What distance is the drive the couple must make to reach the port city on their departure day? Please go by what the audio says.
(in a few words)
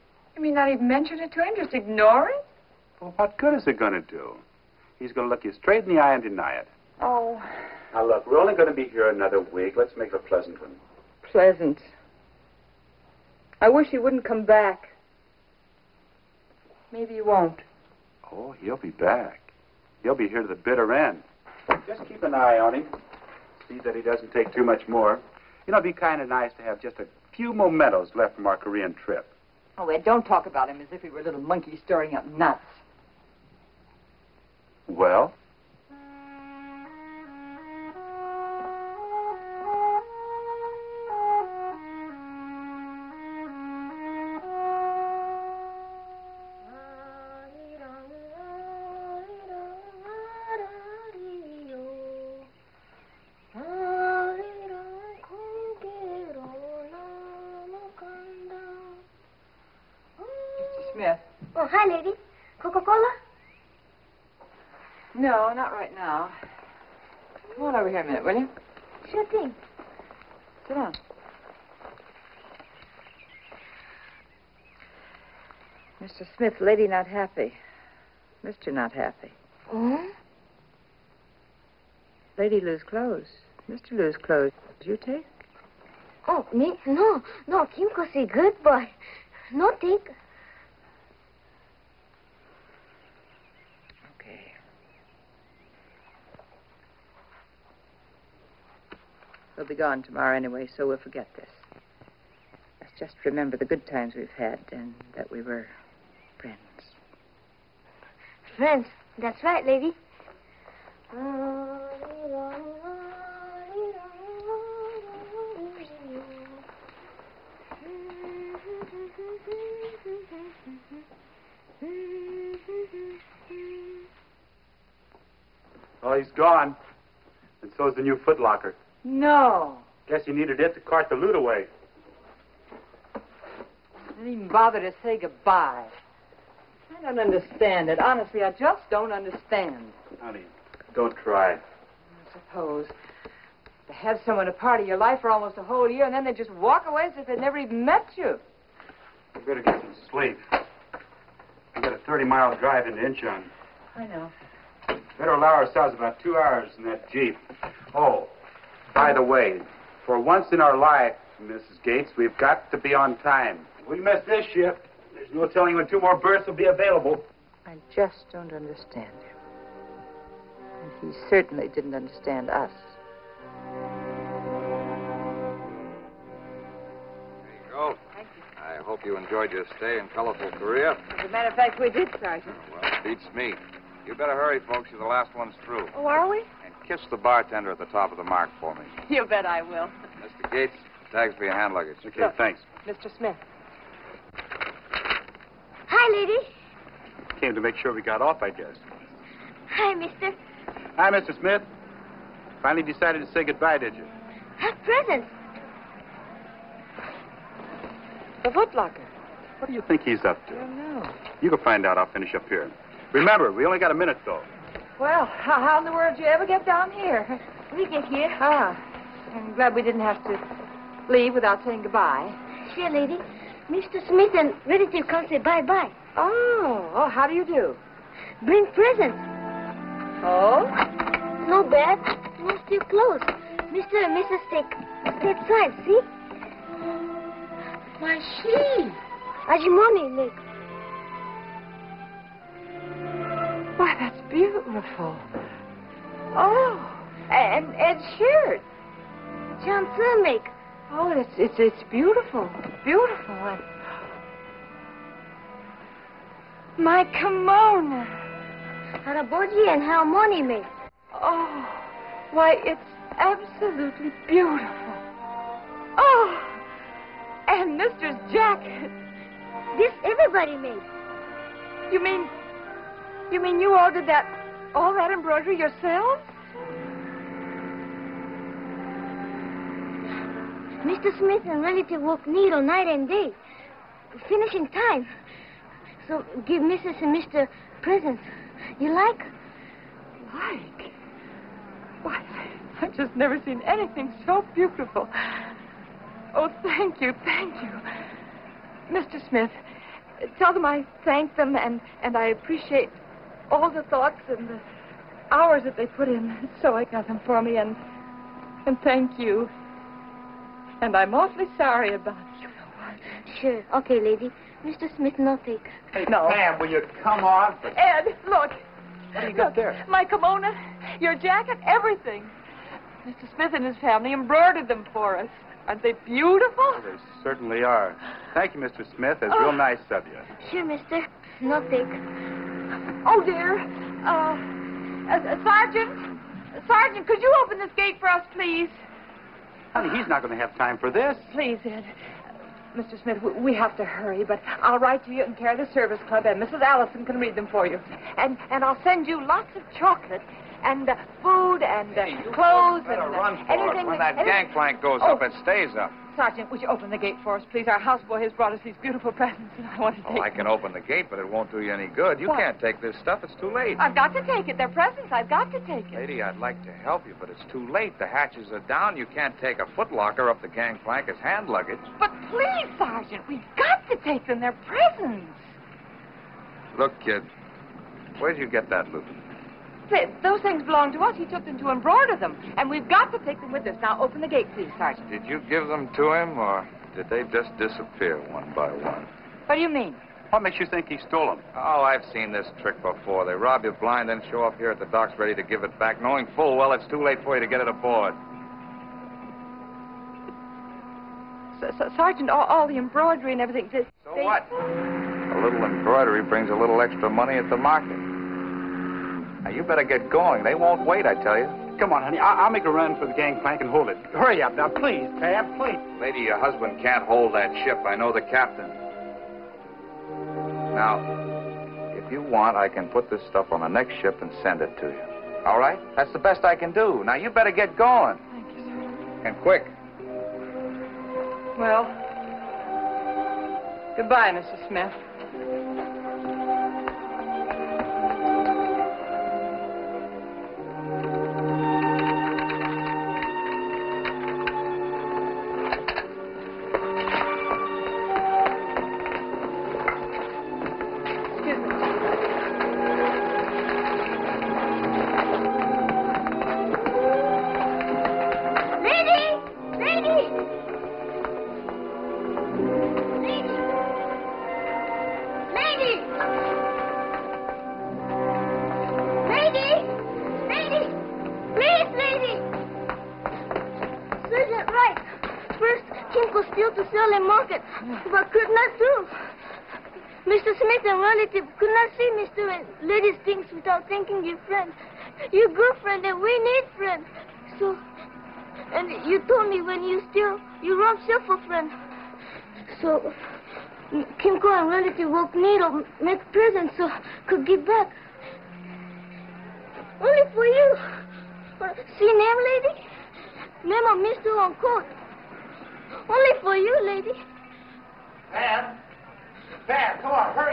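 30 miles.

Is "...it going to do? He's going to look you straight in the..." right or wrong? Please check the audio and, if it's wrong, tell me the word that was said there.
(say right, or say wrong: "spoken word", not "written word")
right.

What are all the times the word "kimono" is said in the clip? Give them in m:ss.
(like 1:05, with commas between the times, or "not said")
4:17, 5:20.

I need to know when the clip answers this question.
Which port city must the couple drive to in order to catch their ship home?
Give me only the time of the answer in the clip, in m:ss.
2:33.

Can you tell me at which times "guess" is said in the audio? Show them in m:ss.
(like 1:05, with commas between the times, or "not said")
2:10, 3:18.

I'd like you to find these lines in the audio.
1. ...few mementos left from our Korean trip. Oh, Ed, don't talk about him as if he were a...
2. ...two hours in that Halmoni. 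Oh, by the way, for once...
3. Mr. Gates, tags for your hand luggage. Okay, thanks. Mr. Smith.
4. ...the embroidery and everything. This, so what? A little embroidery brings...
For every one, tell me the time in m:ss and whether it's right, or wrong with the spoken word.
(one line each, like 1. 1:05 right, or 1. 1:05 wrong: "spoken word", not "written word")
1. 0:27 right
2. 2:36 wrong: "Jeep", not "Halmoni"
3. 3:10 right
4. 6:42 right.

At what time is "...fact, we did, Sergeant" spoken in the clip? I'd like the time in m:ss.
3:01.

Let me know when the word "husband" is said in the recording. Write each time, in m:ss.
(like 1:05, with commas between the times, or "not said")
6:56.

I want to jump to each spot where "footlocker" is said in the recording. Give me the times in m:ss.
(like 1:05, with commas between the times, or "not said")
2:08, 3:28, 6:09.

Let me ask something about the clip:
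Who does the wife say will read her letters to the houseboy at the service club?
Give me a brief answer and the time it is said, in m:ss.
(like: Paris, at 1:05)
Mrs. Allison, at 5:46.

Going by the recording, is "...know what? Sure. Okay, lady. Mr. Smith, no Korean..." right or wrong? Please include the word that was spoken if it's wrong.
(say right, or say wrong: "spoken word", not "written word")
wrong: "Hey", not "Korean".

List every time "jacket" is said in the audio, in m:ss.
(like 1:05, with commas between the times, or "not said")
4:28, 5:21.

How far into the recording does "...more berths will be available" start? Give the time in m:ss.
2:46.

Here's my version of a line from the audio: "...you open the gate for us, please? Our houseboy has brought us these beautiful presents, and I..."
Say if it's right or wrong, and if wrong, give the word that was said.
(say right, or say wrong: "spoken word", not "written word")
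right.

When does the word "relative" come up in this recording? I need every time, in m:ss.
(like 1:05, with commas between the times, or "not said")
3:44, 8:14.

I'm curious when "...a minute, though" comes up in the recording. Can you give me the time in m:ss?
3:33.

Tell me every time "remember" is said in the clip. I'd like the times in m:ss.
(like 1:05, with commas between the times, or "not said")
1:43, 3:33.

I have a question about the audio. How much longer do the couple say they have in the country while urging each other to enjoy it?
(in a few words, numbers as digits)
another week.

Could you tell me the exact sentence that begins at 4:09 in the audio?
Johnson Oh, it's it's it's beautiful, beautiful.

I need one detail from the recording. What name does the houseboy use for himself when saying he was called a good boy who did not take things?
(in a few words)
Kimko.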